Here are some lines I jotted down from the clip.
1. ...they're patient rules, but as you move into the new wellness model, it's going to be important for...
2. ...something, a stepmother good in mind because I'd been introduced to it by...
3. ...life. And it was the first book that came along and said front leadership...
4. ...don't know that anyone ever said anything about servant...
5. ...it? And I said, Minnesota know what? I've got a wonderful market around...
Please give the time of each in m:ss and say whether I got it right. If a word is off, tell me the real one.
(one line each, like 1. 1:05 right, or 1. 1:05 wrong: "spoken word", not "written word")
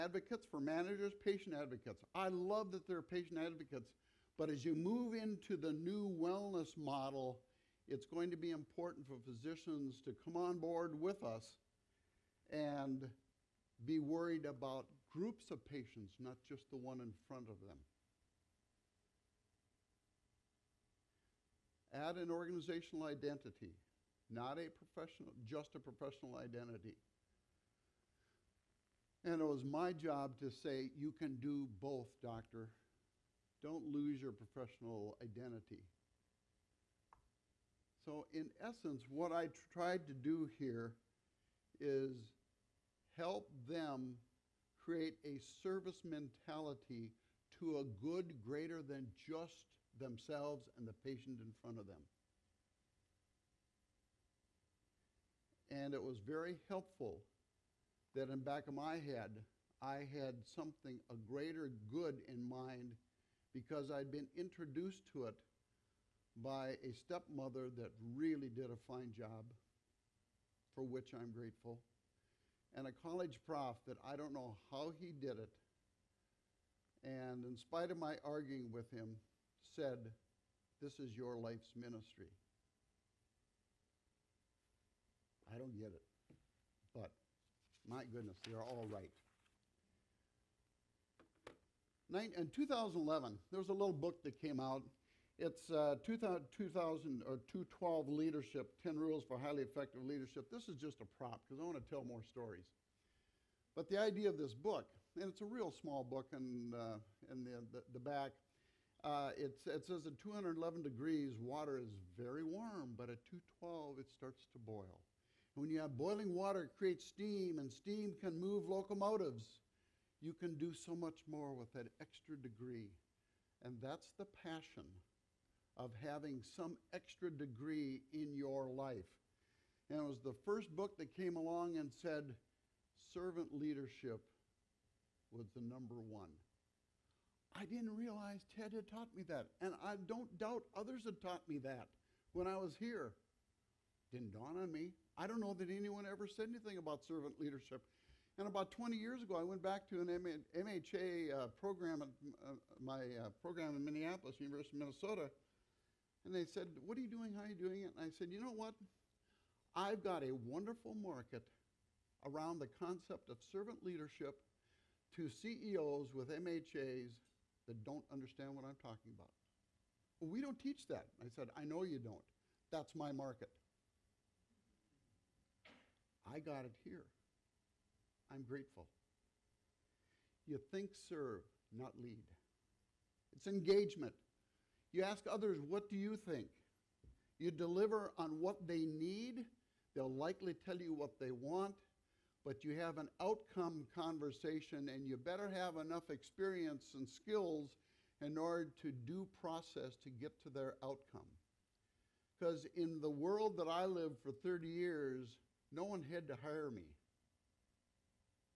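1. 0:02 wrong: "advocates", not "rules"
2. 1:00 wrong: "greater", not "stepmother"
3. 2:08 wrong: "servant", not "front"
4. 2:25 right
5. 2:37 wrong: "You", not "Minnesota".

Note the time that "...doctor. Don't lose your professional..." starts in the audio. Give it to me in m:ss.
0:32.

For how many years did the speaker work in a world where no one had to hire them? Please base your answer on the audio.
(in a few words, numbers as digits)
30.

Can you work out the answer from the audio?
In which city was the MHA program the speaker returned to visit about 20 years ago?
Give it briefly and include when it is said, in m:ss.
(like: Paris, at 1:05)
Minneapolis, at 2:33.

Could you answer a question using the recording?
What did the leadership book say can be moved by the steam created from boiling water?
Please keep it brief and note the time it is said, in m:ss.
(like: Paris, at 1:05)
locomotives, at 1:58.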